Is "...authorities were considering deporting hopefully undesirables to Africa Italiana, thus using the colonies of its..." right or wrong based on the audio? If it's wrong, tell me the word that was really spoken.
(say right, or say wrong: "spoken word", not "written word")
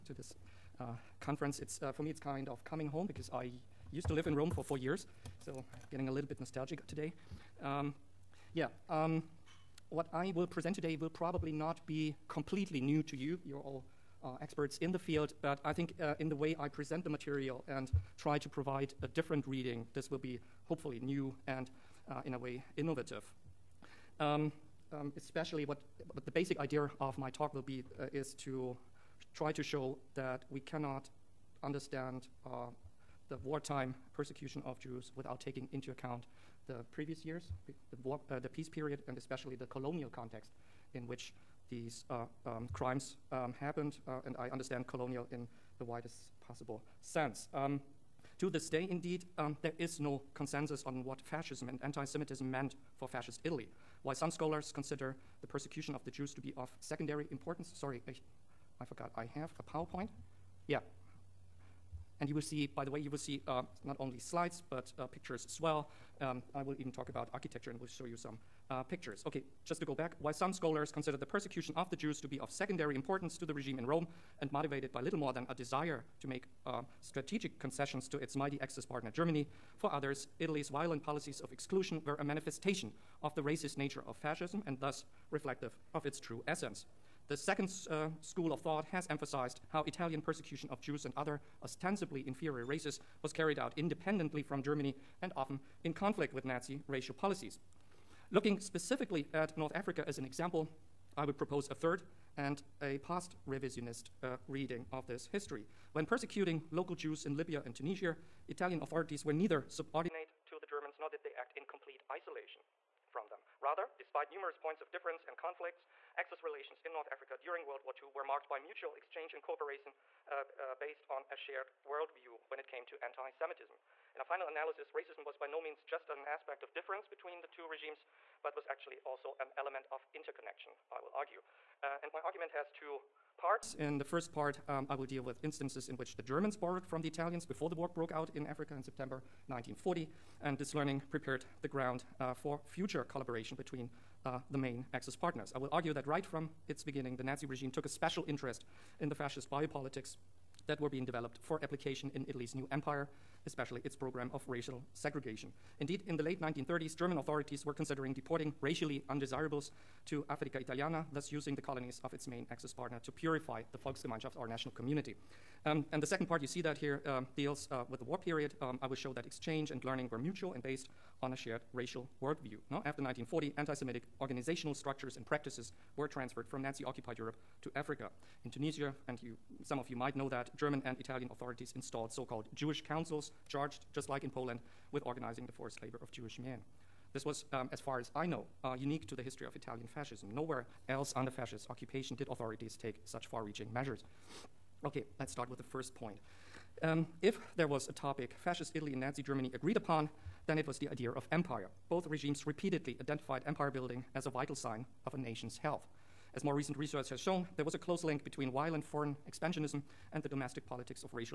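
wrong: "racially", not "hopefully".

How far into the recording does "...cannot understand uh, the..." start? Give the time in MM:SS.
00:30.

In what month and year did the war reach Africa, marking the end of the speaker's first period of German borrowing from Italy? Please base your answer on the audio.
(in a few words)
September 1940.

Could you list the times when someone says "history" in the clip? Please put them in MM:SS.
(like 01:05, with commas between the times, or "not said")
01:45, 03:09.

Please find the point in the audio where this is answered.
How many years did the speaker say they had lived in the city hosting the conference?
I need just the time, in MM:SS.
00:04.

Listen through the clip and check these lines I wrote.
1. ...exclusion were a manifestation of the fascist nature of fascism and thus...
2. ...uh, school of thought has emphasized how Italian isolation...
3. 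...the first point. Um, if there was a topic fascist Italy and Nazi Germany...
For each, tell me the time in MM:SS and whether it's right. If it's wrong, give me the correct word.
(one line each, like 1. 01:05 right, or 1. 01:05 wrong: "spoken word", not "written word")
1. 01:21 wrong: "racist", not "fascist"
2. 01:27 wrong: "persecution", not "isolation"
3. 03:15 right.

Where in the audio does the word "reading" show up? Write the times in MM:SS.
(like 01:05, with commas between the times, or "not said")
00:19, 01:44.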